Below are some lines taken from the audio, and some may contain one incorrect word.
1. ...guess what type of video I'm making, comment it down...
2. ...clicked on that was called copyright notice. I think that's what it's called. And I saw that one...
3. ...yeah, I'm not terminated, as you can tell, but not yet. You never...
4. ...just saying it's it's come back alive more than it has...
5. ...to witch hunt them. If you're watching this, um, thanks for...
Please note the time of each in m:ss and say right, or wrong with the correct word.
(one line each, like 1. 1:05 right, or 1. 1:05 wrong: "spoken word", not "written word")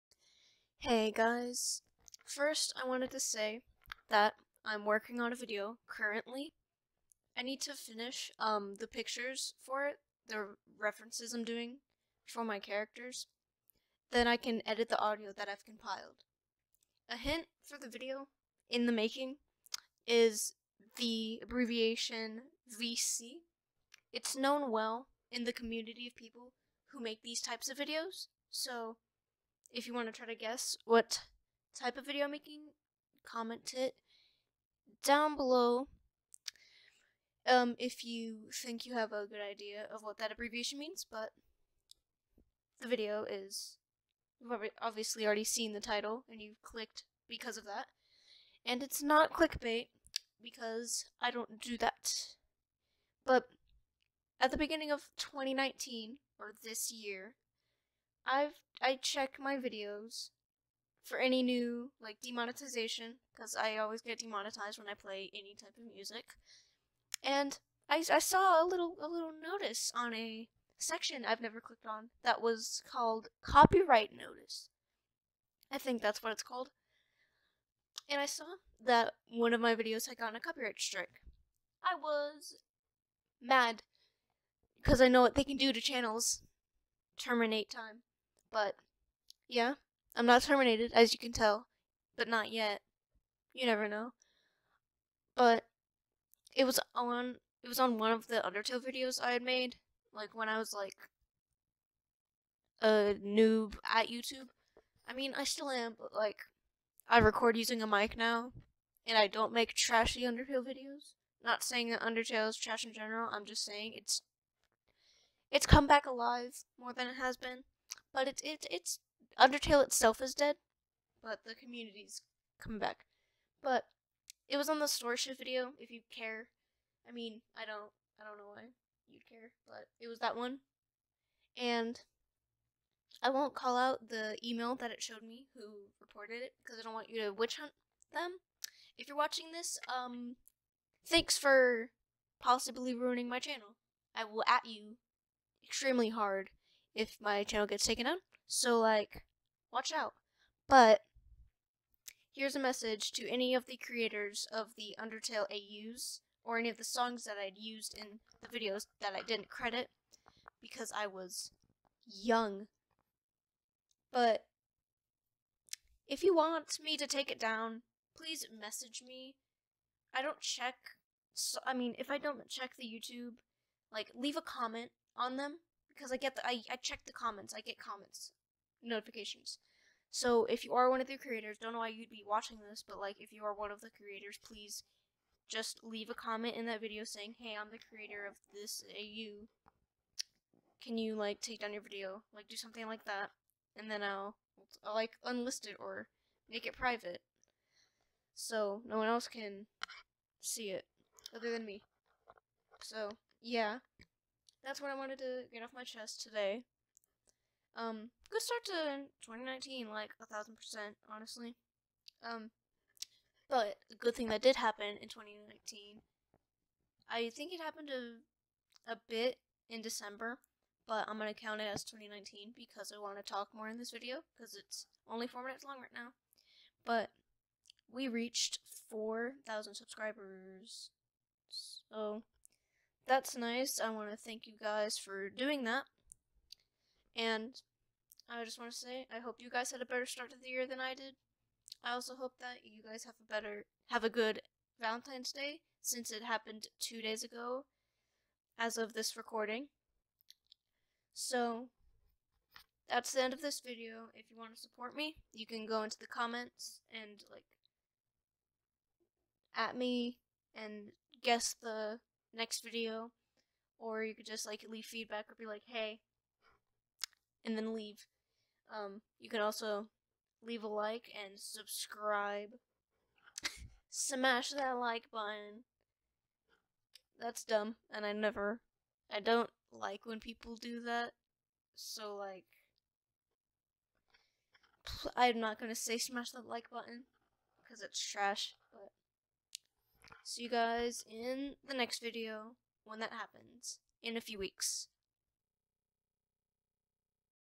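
1. 0:30 right
2. 1:11 right
3. 1:29 right
4. 1:53 right
5. 2:17 right.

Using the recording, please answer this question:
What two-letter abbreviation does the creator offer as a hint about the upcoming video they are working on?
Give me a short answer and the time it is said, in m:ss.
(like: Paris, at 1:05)
VC, at 0:22.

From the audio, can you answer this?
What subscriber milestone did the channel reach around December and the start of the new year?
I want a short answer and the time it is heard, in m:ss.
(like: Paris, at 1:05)
4,000, at 3:48.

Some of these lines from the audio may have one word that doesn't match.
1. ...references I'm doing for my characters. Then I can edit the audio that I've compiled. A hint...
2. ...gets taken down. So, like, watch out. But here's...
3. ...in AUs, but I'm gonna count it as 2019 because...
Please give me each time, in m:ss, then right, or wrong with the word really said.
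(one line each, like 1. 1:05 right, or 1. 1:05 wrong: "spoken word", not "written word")
1. 0:10 right
2. 2:27 right
3. 3:39 wrong: "December", not "AUs".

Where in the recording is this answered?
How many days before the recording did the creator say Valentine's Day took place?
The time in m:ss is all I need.
4:06.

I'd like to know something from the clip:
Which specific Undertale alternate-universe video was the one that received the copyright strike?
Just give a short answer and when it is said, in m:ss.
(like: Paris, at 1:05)
Storyshift, at 2:04.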